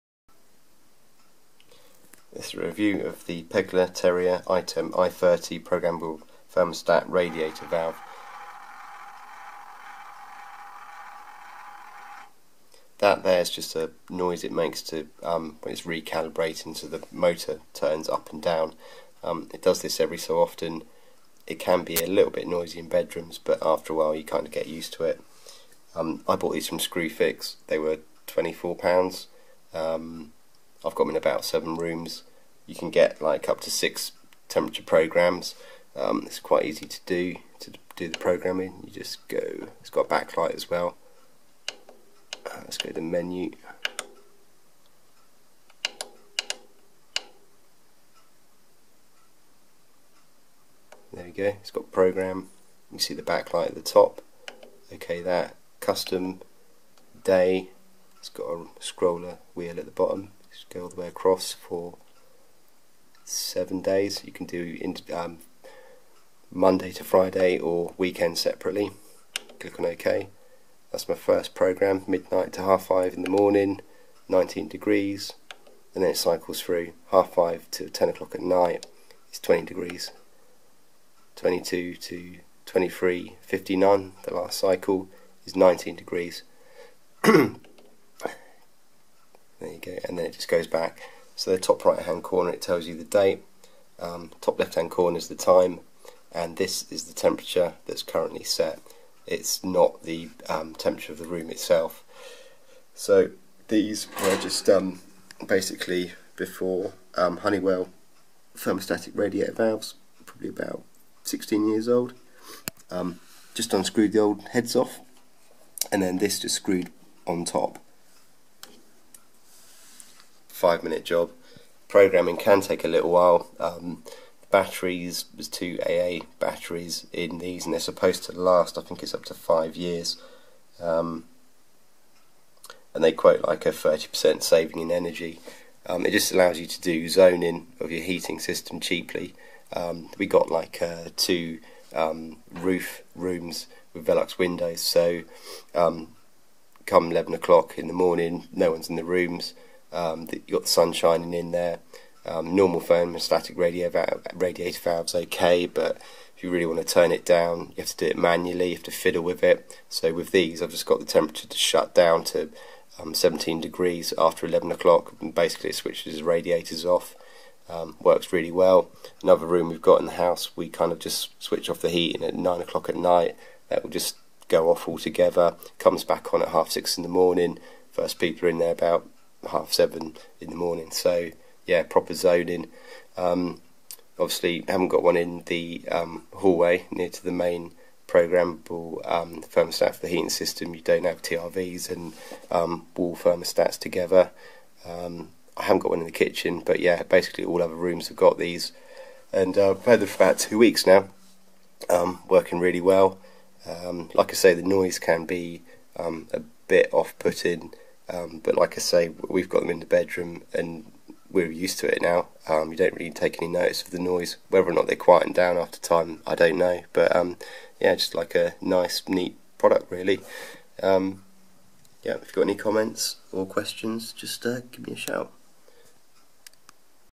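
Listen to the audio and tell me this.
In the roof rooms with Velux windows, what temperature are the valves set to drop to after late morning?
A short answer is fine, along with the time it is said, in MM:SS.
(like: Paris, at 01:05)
17 degrees, at 02:43.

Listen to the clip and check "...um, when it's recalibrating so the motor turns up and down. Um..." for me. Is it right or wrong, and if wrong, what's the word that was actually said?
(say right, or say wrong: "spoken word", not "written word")
right.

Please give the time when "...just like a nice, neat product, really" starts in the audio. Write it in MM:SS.
03:37.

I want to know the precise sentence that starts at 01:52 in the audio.
Um, just unscrewed the old heads off, and then this just screwed on top five minute job.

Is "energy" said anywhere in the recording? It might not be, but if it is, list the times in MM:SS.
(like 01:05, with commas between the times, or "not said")
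02:14.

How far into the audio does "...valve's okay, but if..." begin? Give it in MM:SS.
02:34.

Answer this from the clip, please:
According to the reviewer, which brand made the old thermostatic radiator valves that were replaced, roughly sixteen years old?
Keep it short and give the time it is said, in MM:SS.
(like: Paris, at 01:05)
Honeywell, at 01:47.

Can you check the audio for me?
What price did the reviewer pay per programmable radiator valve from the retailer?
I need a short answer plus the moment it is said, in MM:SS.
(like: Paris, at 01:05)
£24, at 00:28.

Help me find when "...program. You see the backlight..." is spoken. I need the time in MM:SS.
00:51.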